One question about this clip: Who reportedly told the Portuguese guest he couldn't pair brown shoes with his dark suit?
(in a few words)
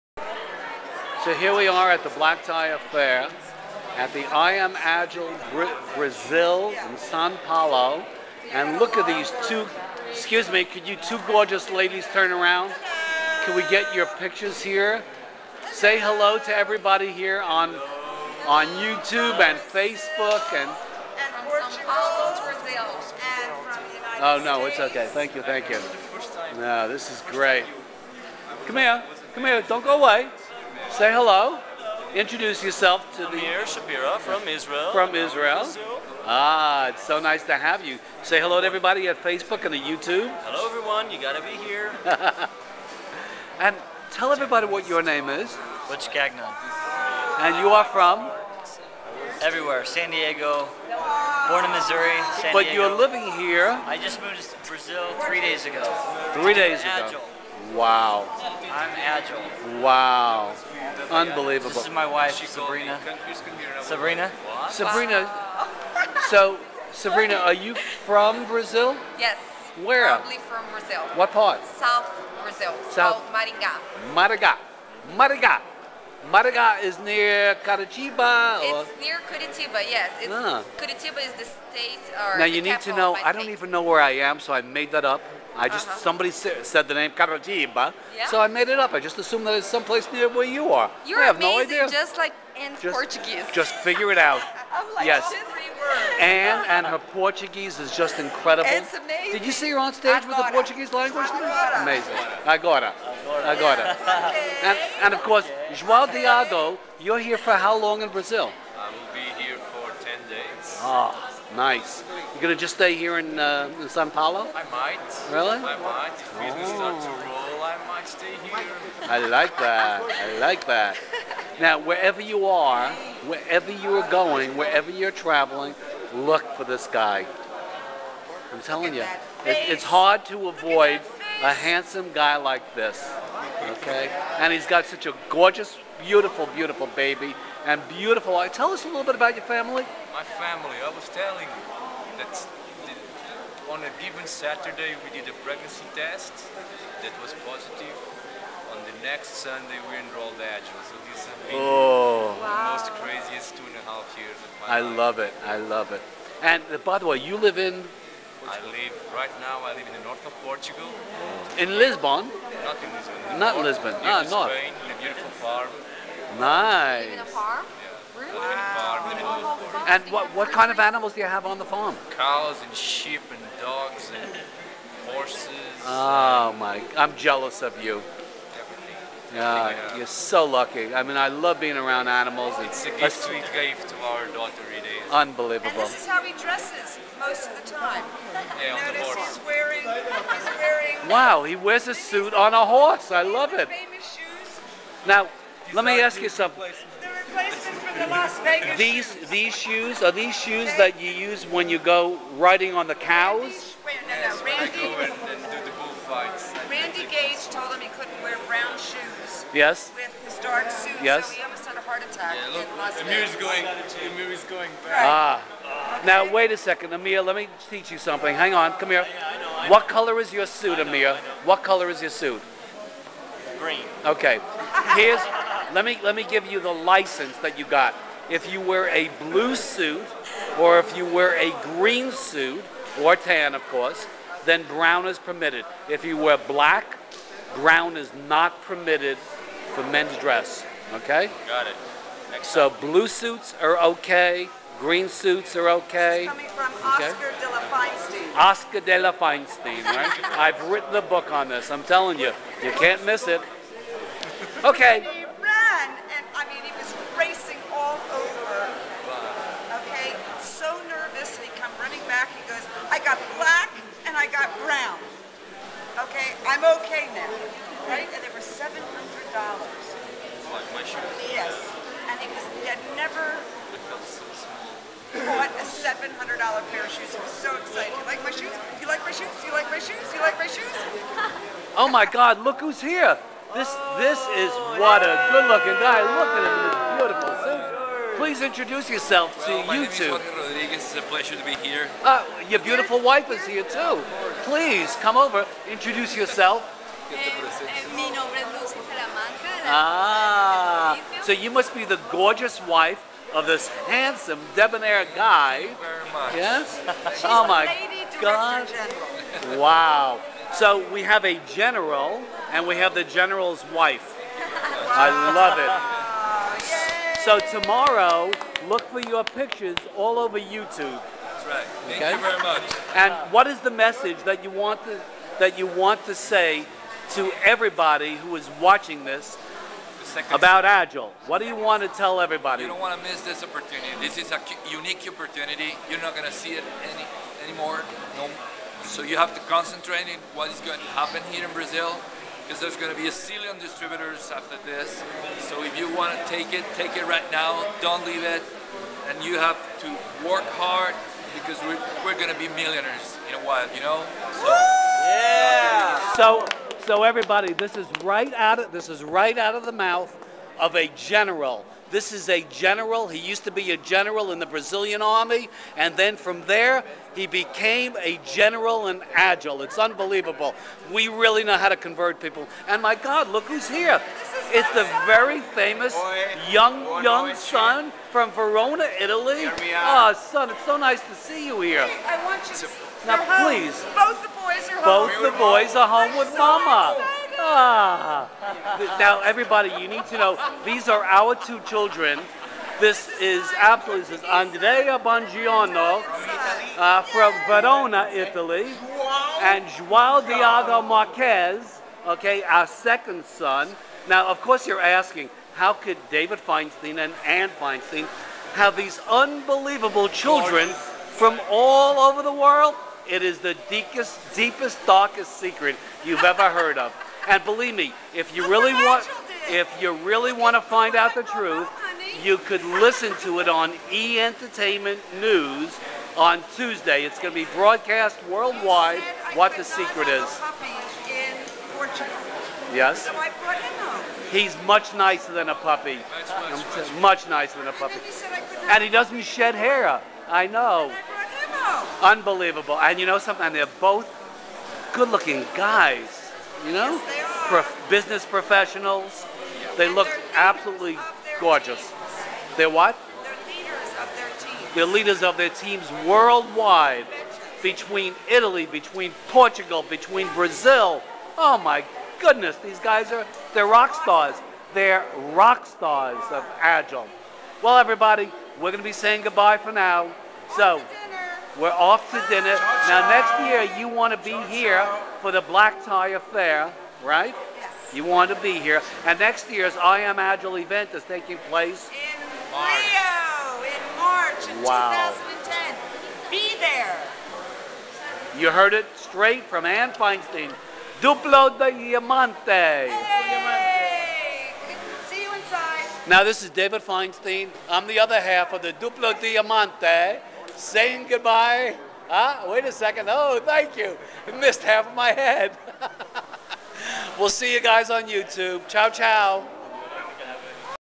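Randy Gage.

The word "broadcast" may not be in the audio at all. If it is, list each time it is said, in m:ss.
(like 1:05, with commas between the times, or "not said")
7:07.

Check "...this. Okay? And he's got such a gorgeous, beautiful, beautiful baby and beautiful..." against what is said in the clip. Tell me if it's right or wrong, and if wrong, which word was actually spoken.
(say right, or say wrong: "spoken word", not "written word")
right.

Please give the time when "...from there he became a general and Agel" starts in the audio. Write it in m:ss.
6:06.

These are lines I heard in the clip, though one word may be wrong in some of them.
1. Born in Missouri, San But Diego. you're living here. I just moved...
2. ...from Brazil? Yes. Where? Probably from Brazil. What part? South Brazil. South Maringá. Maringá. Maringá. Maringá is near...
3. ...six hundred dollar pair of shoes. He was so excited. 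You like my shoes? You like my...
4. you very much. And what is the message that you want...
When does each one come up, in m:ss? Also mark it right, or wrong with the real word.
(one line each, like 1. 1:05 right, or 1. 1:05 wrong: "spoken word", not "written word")
1. 0:51 right
2. 1:07 right
3. 4:35 wrong: "seven", not "six"
4. 5:22 right.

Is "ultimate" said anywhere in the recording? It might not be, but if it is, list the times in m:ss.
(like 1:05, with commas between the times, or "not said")
not said.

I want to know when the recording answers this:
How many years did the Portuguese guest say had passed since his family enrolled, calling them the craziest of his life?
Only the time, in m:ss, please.
2:33.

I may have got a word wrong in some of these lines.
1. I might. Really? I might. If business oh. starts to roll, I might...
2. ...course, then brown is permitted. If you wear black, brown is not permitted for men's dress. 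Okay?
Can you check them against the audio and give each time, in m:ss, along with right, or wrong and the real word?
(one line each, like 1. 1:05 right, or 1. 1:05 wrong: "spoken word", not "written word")
1. 1:54 right
2. 3:53 right.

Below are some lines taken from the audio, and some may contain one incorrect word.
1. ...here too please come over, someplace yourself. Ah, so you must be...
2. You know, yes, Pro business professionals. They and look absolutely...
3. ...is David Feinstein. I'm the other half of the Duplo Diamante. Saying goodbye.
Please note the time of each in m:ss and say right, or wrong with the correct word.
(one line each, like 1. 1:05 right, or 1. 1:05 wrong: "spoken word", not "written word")
1. 4:53 wrong: "introduce", not "someplace"
2. 7:26 right
3. 8:16 right.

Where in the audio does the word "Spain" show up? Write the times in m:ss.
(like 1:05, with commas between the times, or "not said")
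2:44.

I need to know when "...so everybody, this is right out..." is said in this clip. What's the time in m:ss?
5:56.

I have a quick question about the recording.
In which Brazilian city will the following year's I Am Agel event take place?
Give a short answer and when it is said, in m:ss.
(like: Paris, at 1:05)
Rio, at 8:02.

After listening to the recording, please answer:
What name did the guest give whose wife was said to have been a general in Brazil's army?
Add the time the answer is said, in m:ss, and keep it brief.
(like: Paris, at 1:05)
Jorge Rodriguez, at 4:50.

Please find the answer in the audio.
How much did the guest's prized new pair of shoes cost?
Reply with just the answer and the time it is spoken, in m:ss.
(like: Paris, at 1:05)
$700, at 4:28.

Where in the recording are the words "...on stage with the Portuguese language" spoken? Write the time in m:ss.
1:39.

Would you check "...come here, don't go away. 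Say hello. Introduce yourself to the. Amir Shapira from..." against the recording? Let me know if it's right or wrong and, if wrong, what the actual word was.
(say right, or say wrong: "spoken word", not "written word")
right.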